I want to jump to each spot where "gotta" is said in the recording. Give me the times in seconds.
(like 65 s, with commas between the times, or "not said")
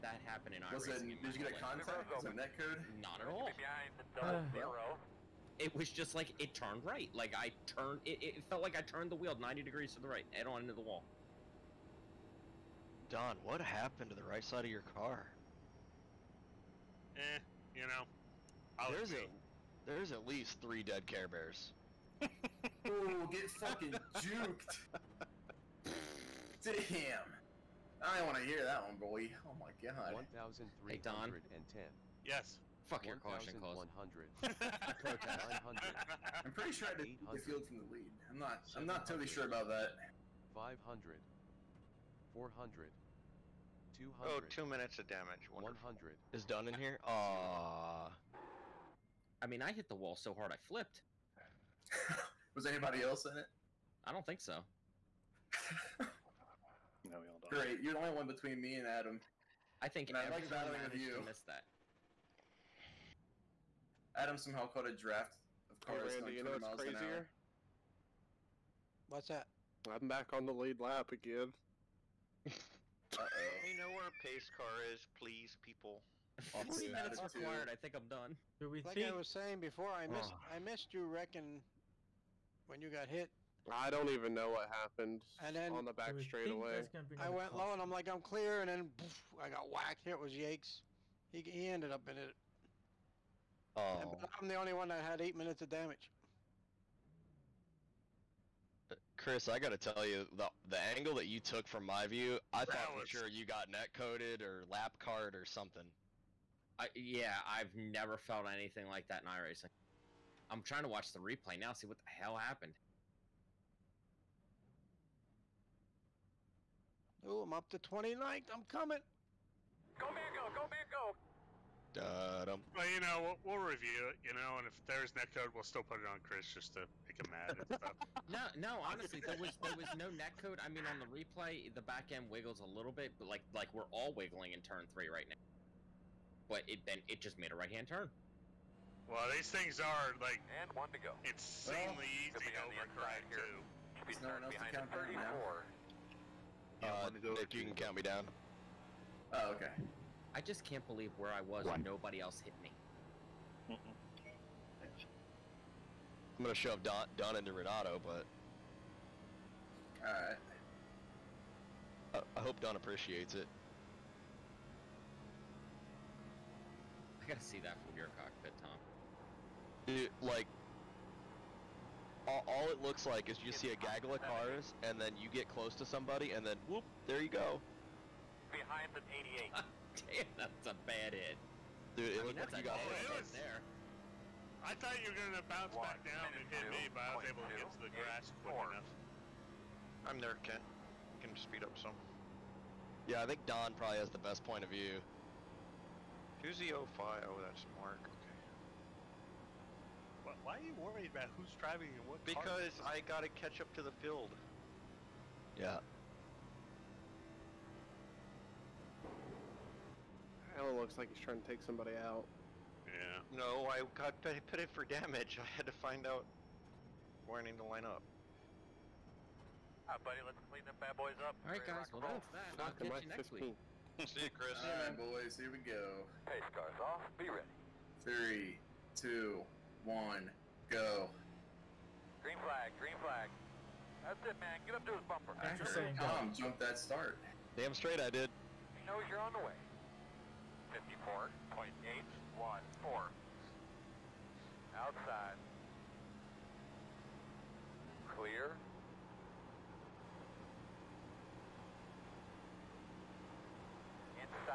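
99 s, 167 s.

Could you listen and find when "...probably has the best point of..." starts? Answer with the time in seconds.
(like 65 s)
193 s.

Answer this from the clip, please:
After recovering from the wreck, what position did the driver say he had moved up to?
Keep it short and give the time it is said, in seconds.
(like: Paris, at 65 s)
29th, at 117 s.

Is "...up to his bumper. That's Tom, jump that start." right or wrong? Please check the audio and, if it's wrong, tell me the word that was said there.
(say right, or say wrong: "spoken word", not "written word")
right.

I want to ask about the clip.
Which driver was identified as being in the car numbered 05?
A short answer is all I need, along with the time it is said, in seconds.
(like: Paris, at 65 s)
Mark, at 197 s.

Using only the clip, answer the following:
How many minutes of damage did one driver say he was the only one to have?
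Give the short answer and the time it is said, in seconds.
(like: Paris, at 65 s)
8, at 95 s.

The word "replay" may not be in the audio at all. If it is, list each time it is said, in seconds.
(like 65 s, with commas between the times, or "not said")
111 s, 131 s.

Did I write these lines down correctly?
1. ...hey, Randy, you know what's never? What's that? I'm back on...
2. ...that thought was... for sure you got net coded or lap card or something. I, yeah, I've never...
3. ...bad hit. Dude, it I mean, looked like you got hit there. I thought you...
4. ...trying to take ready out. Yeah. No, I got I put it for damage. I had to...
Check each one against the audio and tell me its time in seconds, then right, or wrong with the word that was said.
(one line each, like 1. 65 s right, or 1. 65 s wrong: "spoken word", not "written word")
1. 66 s wrong: "crazier", not "never"
2. 102 s right
3. 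180 s right
4. 211 s wrong: "somebody", not "ready".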